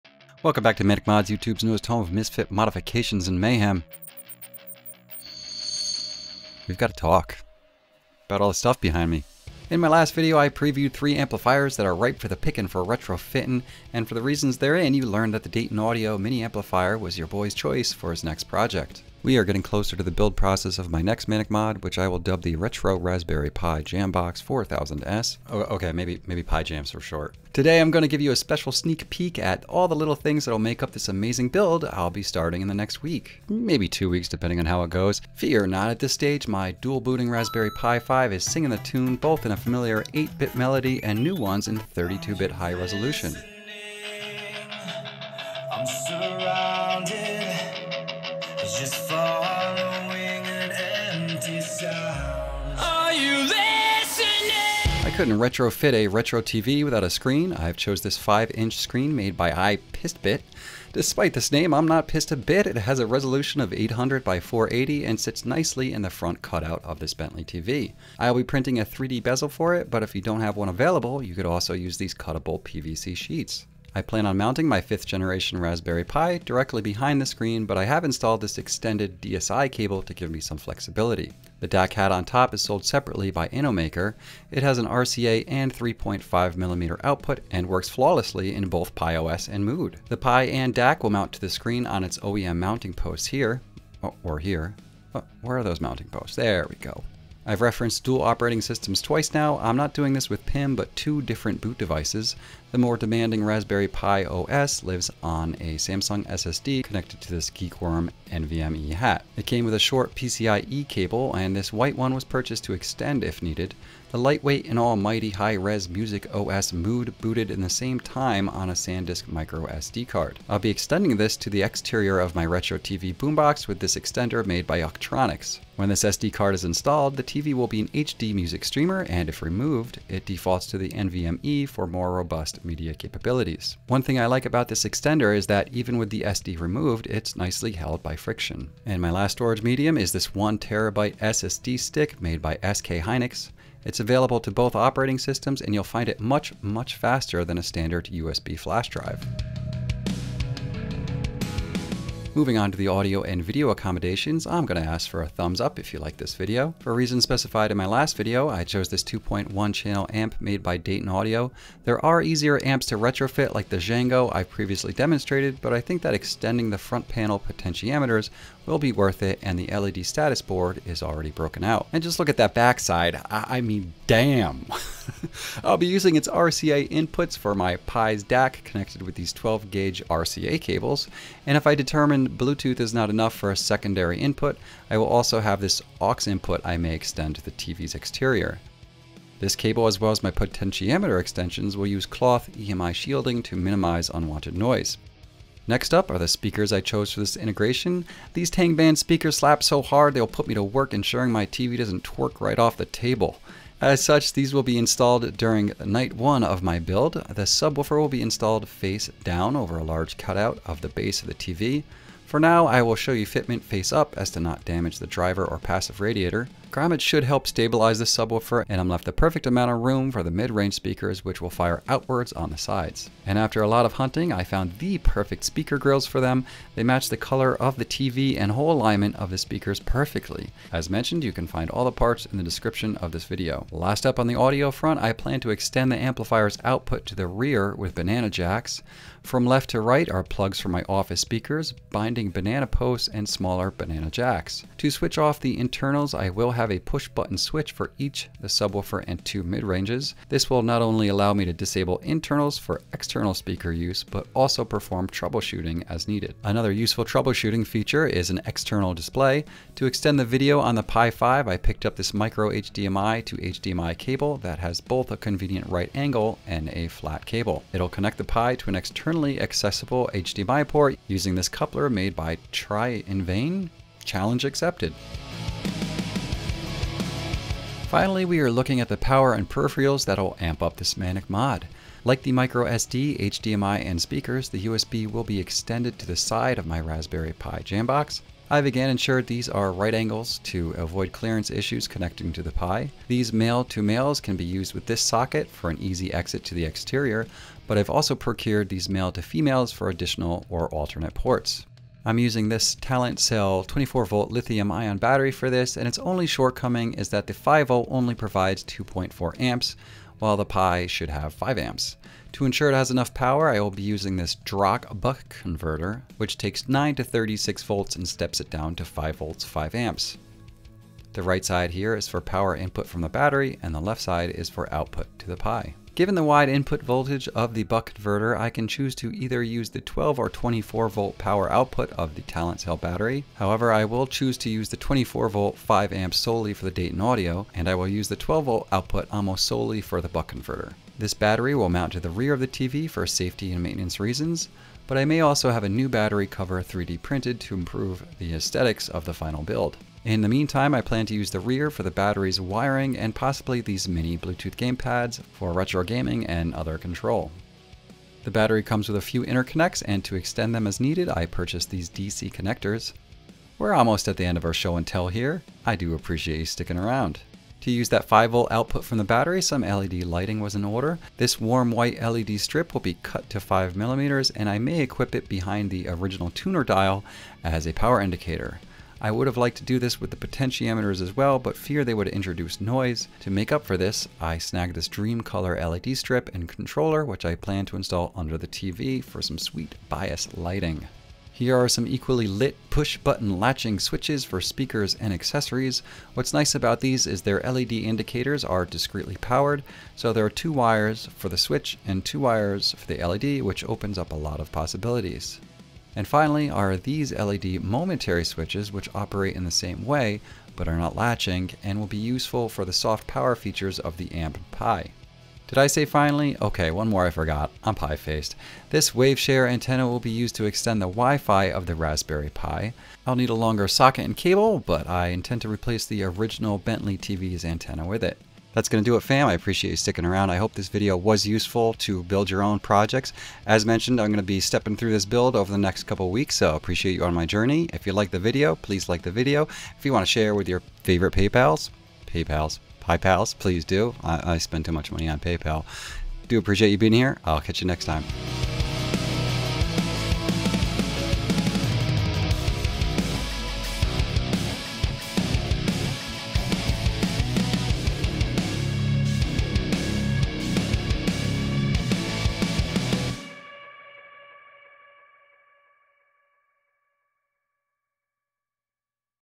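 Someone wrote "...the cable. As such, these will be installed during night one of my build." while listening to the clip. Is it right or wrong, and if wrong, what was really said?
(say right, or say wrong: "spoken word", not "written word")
wrong: "table", not "cable".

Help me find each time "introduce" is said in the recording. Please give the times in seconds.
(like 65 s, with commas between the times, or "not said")
382 s.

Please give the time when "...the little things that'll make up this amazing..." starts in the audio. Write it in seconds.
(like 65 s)
29 s.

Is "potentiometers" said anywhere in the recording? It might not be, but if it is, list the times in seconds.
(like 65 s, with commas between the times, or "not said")
167 s, 190 s, 380 s.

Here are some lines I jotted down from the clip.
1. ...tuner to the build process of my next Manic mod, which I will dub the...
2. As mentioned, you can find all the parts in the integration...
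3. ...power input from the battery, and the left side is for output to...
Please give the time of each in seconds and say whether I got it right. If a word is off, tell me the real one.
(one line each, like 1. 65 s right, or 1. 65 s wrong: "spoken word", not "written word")
1. 19 s wrong: "closer", not "tuner"
2. 230 s wrong: "description", not "integration"
3. 322 s right.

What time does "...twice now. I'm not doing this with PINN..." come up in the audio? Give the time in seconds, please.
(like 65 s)
99 s.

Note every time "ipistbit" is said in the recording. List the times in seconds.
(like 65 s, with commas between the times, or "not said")
59 s.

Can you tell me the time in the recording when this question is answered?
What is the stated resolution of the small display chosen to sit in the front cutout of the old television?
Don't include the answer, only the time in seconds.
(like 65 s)
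63 s.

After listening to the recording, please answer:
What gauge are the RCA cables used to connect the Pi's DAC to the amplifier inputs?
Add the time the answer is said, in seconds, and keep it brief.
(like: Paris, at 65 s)
12 gauge, at 179 s.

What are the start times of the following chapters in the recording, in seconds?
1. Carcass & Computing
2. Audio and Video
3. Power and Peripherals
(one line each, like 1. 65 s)
1. 52 s
2. 150 s
3. 275 s.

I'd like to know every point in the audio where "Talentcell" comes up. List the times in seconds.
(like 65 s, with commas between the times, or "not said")
302 s, 332 s.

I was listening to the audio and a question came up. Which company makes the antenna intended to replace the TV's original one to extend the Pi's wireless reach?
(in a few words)
WaveShare.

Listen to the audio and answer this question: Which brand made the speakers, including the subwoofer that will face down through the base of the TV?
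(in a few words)
Tang Band.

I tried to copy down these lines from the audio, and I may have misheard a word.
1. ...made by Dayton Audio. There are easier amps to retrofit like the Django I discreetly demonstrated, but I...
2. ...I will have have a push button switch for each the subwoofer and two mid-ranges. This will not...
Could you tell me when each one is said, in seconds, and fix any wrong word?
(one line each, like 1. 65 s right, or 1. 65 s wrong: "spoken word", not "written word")
1. 160 s wrong: "previously", not "discreetly"
2. 246 s right.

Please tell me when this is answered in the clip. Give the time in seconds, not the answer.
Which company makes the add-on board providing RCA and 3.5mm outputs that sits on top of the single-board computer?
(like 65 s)
83 s.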